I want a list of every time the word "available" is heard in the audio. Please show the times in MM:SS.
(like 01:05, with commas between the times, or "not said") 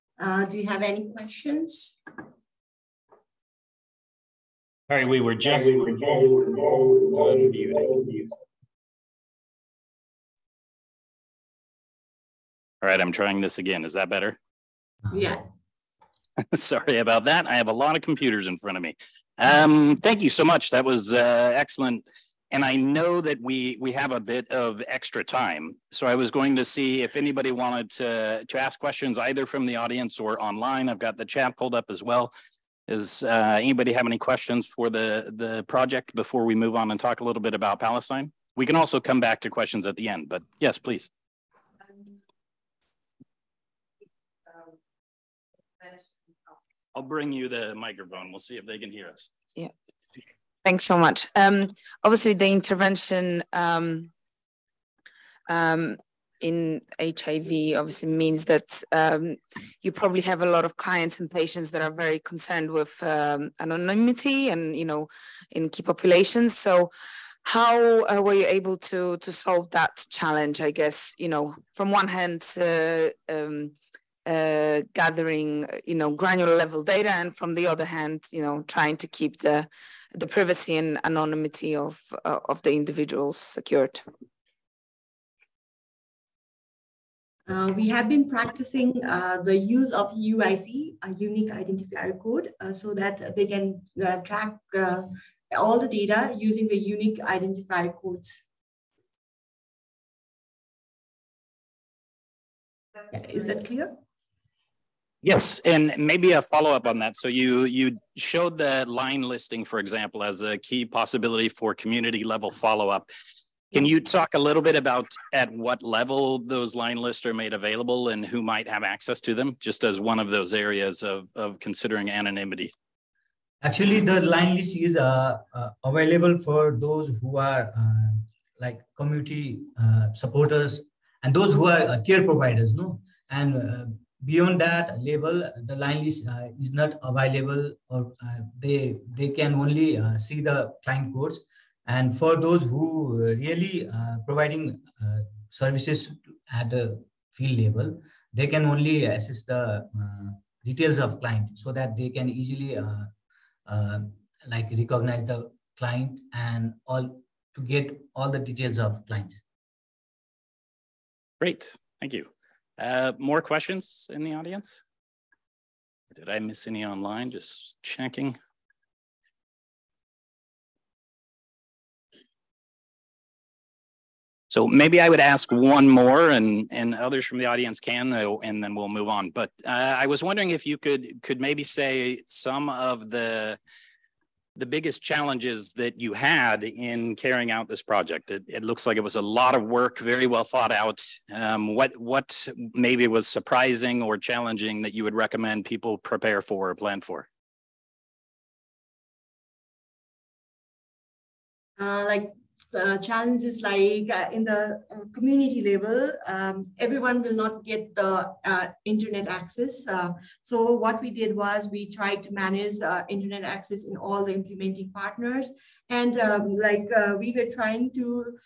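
01:57, 02:05, 02:17.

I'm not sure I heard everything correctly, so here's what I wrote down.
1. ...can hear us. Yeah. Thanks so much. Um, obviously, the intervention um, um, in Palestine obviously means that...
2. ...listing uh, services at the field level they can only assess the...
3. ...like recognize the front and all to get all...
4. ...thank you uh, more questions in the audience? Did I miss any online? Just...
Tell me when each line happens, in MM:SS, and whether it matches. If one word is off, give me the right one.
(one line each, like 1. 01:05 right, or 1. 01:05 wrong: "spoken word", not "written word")
1. 00:48 wrong: "HIV", not "Palestine"
2. 02:24 wrong: "providing", not "listing"
3. 02:34 wrong: "client", not "front"
4. 02:41 right.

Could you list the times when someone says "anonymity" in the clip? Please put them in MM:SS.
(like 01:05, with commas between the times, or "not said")
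01:03, 01:21, 02:02.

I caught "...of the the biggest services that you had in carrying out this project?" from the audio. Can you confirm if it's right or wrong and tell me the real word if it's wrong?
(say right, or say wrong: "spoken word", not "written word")
wrong: "challenges", not "services".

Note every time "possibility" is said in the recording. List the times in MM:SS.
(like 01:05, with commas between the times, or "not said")
01:50.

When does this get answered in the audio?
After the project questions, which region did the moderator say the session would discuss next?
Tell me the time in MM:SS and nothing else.
00:37.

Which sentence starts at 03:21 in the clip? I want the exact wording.
Uh, like uh, challenges like uh, in the uh, community level, um, everyone will not get the uh, internet access.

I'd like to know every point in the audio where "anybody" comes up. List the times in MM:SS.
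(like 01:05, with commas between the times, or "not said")
00:27, 00:33.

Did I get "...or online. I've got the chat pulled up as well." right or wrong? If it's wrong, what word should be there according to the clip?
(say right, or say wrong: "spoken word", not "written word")
right.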